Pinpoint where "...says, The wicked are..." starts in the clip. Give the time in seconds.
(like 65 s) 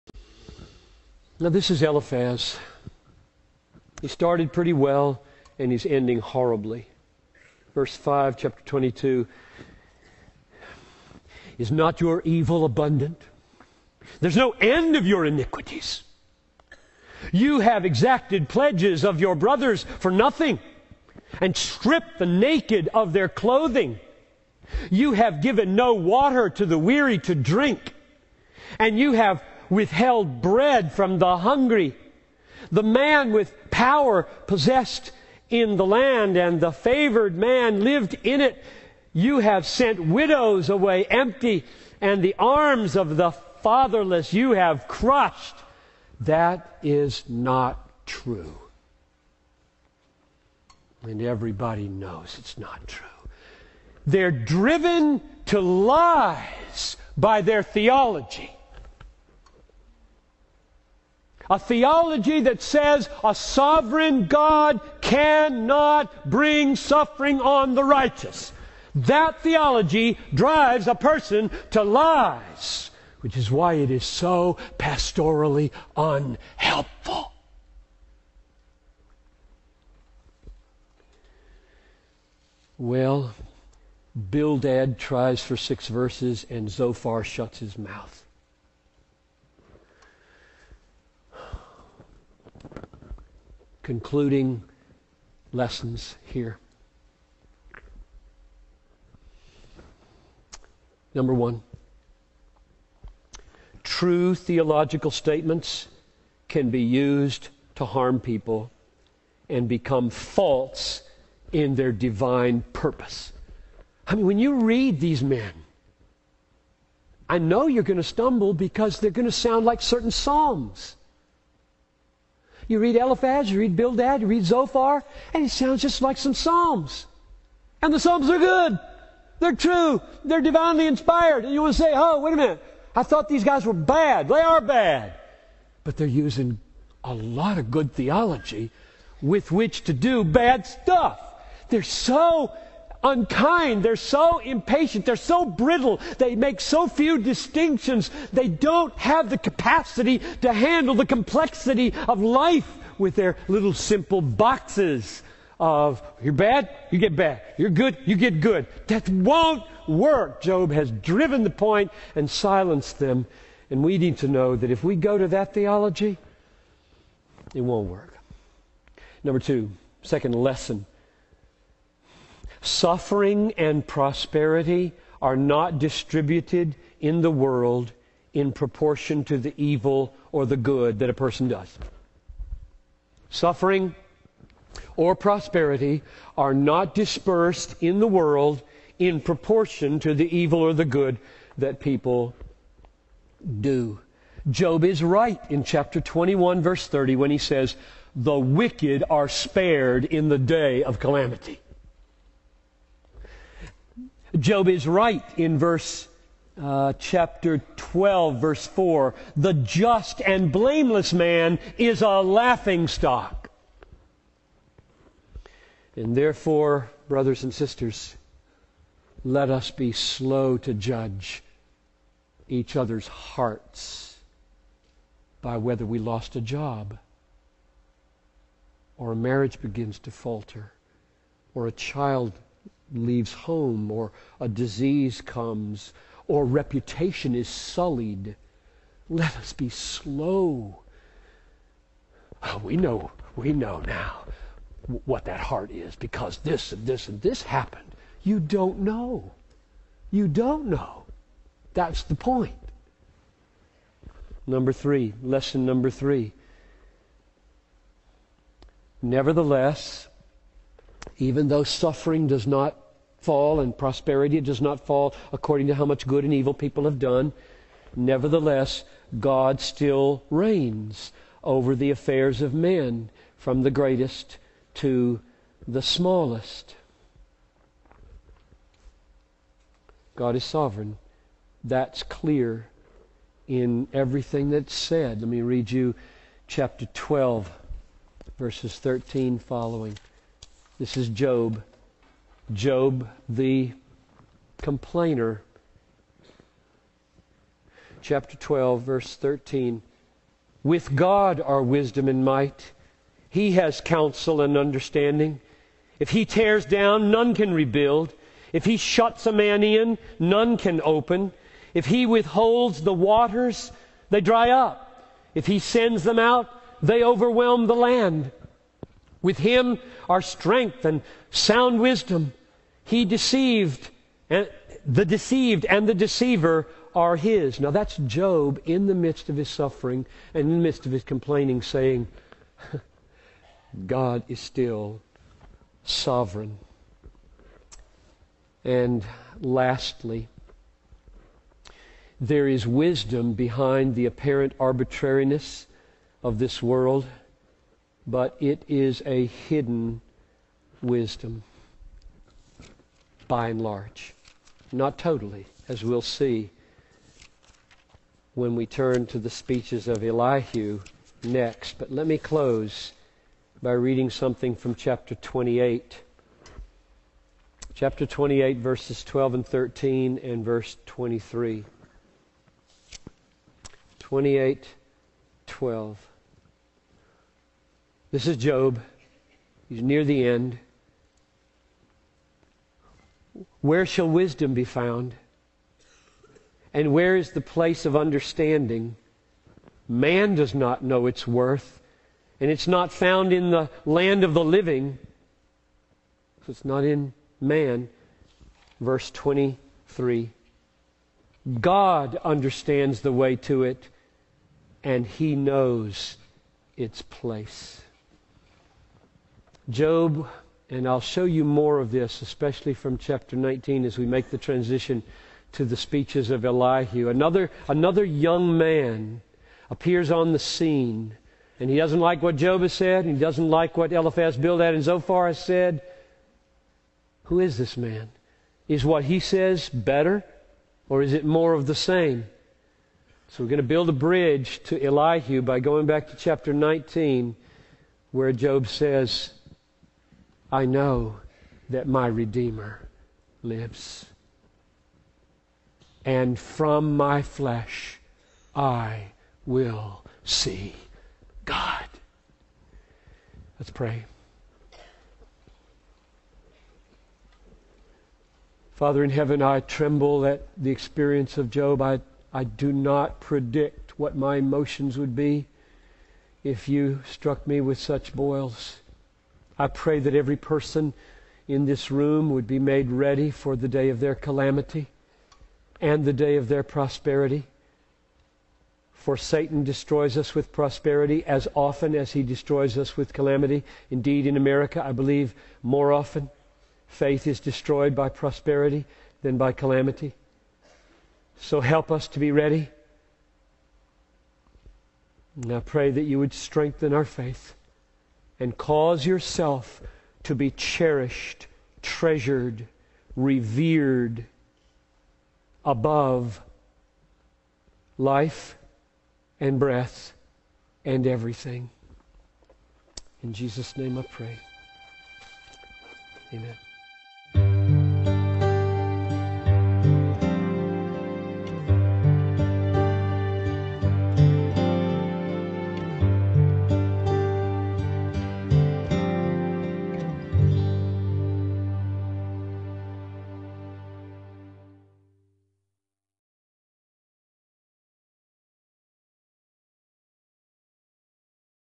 197 s.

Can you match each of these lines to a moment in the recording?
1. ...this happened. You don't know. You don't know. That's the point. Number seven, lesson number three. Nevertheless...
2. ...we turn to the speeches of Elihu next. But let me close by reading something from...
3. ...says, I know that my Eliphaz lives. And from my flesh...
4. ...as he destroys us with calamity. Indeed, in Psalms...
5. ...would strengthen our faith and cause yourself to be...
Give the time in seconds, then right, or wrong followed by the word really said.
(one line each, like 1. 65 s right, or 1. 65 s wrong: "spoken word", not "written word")
1. 247 s wrong: "three", not "seven"
2. 358 s right
3. 438 s wrong: "Redeemer", not "Eliphaz"
4. 481 s wrong: "America", not "Psalms"
5. 496 s right.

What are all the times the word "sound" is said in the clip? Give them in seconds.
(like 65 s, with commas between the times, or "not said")
119 s, 125 s, 321 s.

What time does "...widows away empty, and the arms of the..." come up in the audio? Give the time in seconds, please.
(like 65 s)
40 s.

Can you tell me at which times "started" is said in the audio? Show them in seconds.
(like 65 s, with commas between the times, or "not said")
4 s.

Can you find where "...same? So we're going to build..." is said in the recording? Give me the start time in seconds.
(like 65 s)
431 s.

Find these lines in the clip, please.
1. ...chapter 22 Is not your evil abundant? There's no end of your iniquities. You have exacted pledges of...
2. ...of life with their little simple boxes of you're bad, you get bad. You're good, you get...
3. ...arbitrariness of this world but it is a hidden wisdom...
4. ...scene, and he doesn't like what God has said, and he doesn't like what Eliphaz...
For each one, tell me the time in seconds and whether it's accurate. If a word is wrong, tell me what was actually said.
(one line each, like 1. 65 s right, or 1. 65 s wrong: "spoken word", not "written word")
1. 8 s right
2. 152 s right
3. 344 s right
4. 420 s wrong: "Job", not "God".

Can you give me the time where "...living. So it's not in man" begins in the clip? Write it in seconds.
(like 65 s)
394 s.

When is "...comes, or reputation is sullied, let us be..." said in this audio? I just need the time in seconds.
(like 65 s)
235 s.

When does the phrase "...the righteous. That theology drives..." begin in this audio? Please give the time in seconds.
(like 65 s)
67 s.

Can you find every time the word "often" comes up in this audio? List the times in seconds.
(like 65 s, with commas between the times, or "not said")
481 s, 485 s.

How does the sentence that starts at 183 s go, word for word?
Suffering or prosperity are not dispersed in the world in proportion to the evil or the good that people do.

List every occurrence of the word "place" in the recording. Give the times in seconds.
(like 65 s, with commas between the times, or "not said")
387 s, 407 s.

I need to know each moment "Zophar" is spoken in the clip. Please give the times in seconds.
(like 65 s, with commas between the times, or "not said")
86 s, 124 s, 424 s.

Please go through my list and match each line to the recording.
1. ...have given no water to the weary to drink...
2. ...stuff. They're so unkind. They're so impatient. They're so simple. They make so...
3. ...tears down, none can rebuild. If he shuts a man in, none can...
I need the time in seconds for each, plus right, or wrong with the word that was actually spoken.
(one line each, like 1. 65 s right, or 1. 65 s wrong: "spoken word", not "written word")
1. 25 s right
2. 140 s wrong: "brittle", not "simple"
3. 306 s right.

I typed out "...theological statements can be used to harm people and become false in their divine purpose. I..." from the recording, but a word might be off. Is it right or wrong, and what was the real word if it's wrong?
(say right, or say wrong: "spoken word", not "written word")
right.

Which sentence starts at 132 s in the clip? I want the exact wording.
I thought these guys were bad.